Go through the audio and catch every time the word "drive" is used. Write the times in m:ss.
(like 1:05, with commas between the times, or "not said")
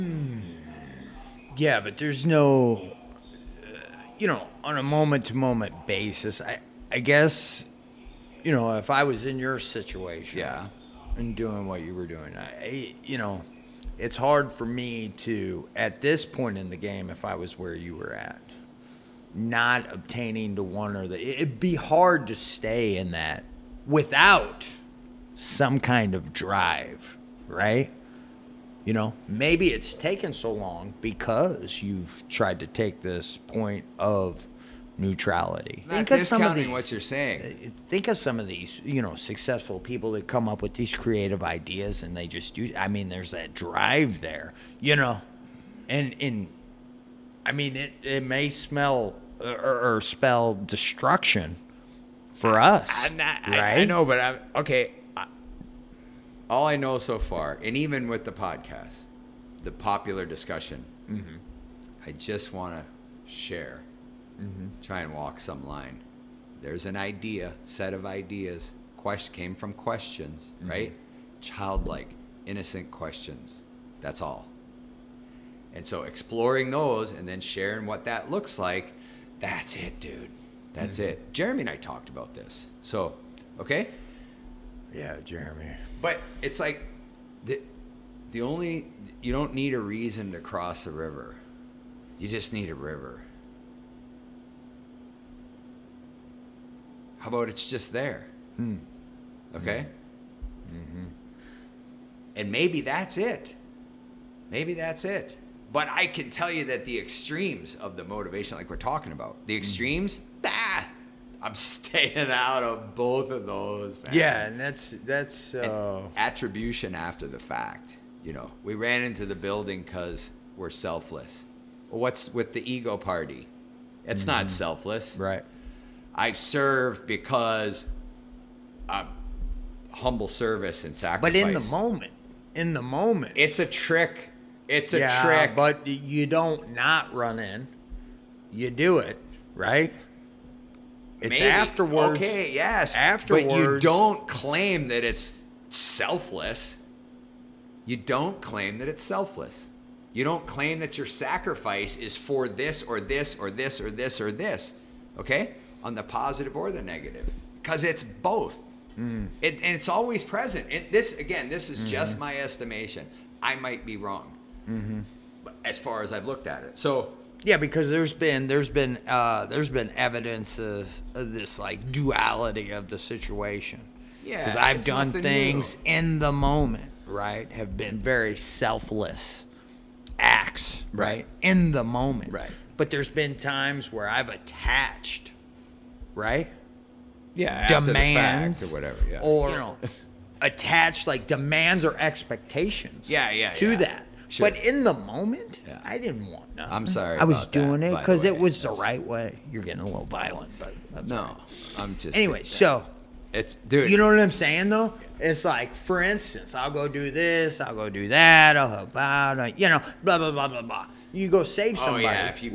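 0:26, 0:43.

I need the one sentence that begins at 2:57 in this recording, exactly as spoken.
Have been very selfless acts, right?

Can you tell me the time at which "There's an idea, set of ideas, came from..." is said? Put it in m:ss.
1:06.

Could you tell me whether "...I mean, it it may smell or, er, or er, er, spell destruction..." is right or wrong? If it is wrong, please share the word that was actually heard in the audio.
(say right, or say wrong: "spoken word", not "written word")
right.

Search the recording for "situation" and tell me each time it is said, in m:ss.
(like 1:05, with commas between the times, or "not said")
0:09, 2:52.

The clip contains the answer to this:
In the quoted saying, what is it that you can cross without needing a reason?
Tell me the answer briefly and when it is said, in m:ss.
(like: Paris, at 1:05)
A river, at 1:32.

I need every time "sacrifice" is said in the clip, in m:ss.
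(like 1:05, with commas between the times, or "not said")
2:10, 2:31.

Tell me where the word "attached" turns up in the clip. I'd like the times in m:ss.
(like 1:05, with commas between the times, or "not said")
3:04, 3:10.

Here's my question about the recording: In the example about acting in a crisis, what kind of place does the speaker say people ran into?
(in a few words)
The building.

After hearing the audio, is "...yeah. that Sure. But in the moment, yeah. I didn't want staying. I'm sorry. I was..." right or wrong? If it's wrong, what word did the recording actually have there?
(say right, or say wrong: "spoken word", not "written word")
wrong: "nothing", not "staying".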